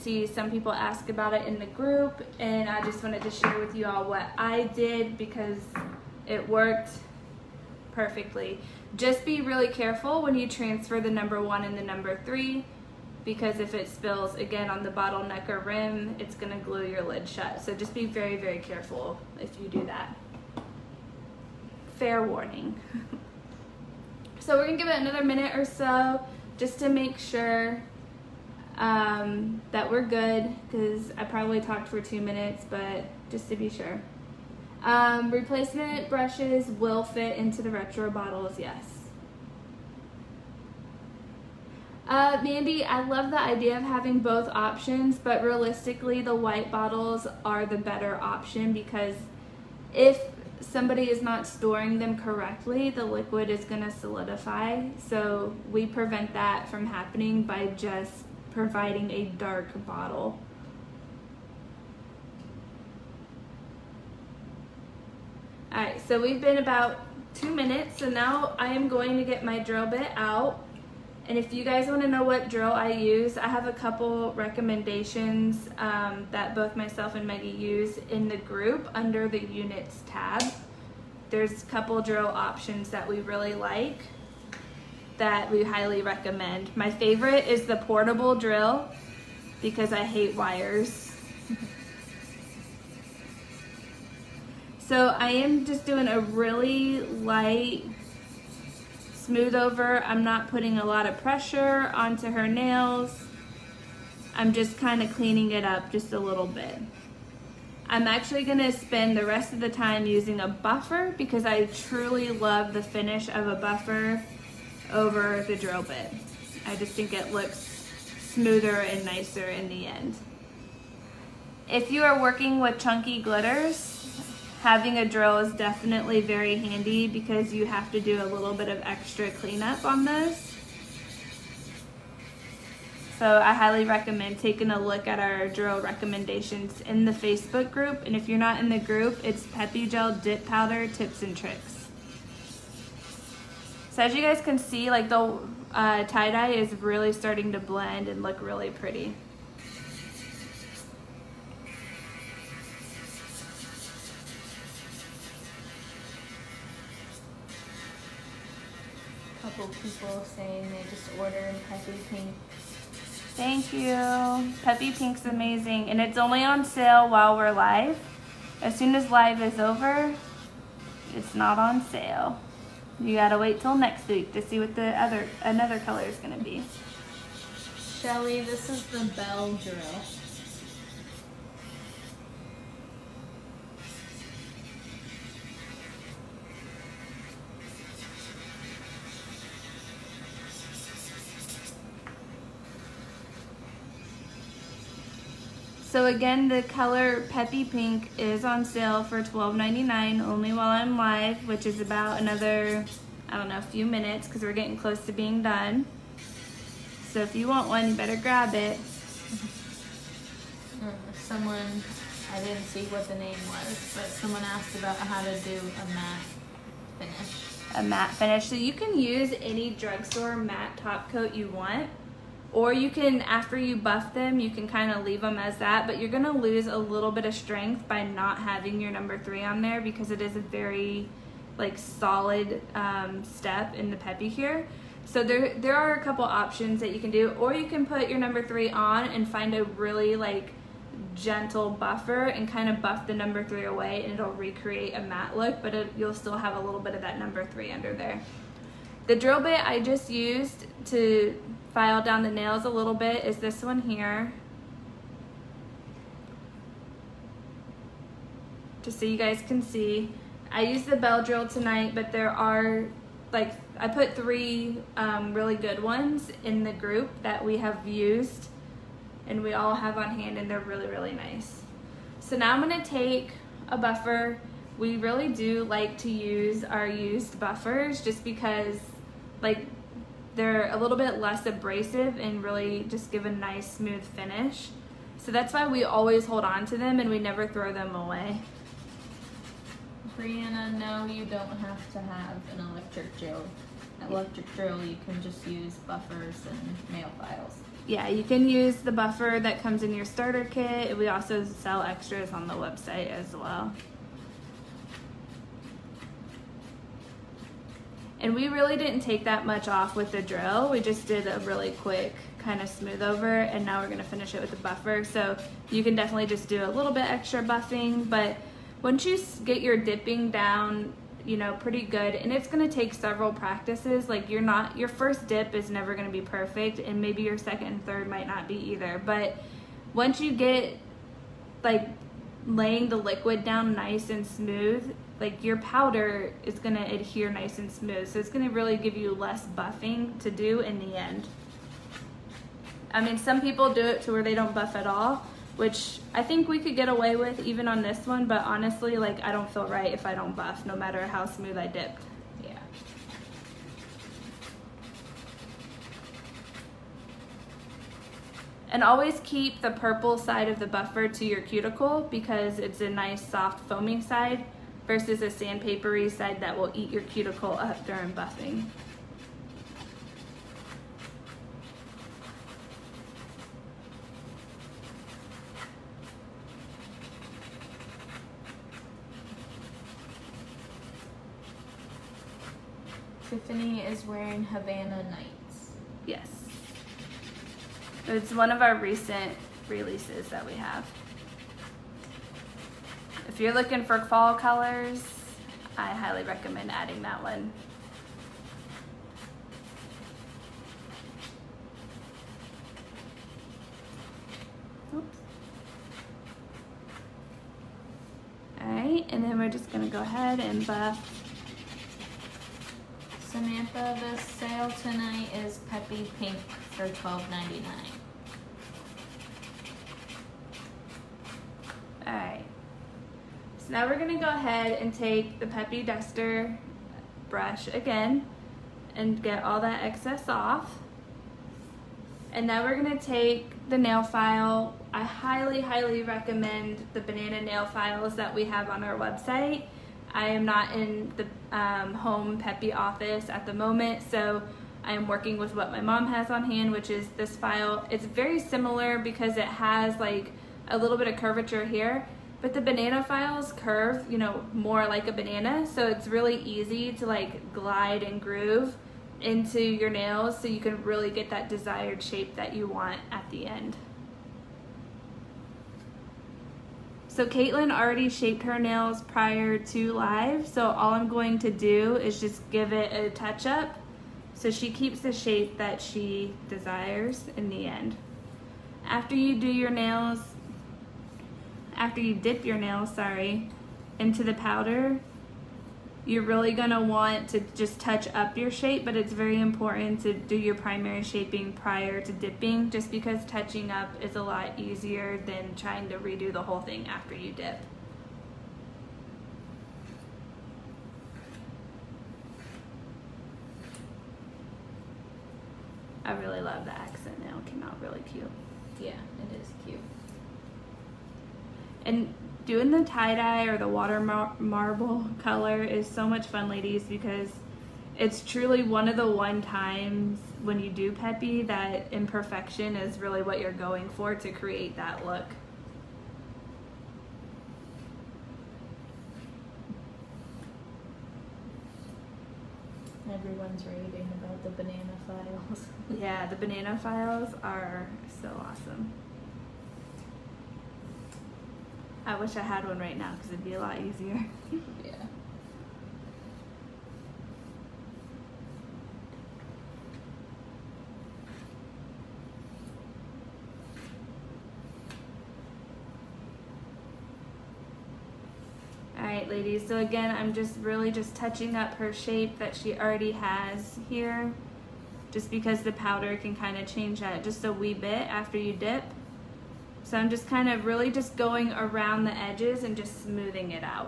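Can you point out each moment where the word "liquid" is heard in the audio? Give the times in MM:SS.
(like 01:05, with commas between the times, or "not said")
00:53, 05:32.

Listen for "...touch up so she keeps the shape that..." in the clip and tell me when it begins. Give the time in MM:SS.
07:53.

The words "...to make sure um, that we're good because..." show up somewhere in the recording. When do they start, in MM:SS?
00:26.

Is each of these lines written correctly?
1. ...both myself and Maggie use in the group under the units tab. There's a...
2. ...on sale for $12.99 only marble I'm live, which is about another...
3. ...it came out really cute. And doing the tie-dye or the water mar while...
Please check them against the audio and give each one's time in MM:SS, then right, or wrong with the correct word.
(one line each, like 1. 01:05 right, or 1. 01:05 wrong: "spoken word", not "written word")
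1. 01:16 right
2. 03:18 wrong: "while", not "marble"
3. 08:27 wrong: "marble", not "while".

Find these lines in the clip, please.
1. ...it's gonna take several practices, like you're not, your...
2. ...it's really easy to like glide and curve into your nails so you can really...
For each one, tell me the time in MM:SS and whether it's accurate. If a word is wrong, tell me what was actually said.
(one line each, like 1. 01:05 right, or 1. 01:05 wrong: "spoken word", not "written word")
1. 05:22 right
2. 07:35 wrong: "groove", not "curve".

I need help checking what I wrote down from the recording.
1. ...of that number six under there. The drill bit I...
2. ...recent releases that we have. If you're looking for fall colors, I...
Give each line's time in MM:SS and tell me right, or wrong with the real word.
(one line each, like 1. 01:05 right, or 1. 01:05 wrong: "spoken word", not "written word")
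1. 04:06 wrong: "three", not "six"
2. 06:28 right.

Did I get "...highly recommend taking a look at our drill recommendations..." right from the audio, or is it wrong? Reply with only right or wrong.
right.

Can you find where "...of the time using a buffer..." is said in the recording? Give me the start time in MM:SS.
01:49.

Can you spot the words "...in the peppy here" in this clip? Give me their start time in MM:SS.
03:53.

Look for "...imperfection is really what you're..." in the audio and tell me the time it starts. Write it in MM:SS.
08:41.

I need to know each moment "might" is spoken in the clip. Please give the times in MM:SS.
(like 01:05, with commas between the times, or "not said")
05:28.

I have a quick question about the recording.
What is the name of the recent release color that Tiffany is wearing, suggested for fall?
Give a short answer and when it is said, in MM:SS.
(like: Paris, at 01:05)
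Havana Nights, at 06:24.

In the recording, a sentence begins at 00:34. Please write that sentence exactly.
Um, replacement brushes will fit into the retro bottles, yes.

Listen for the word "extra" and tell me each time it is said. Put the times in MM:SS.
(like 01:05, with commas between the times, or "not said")
02:08, 05:01, 05:17.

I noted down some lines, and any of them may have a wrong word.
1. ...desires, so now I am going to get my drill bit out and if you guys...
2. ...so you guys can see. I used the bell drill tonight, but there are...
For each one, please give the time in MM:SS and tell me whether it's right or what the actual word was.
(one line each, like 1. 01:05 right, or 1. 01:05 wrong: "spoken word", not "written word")
1. 01:07 wrong: "minutes", not "desires"
2. 04:18 right.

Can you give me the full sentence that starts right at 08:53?
Everyone's raving about the banana files.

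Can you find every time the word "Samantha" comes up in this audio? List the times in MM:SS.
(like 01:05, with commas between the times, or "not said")
06:53.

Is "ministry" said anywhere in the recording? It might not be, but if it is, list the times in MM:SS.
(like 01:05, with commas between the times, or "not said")
not said.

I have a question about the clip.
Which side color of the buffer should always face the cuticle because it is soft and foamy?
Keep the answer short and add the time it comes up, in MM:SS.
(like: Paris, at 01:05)
purple, at 05:59.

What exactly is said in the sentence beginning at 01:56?
I just think it looks smoother and nicer in the end.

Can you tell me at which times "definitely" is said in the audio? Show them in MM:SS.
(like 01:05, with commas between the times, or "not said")
02:05, 05:15.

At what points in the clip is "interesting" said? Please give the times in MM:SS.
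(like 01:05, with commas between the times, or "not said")
not said.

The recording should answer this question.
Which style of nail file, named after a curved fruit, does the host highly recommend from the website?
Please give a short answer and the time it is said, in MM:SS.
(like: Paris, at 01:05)
banana nail files, at 07:16.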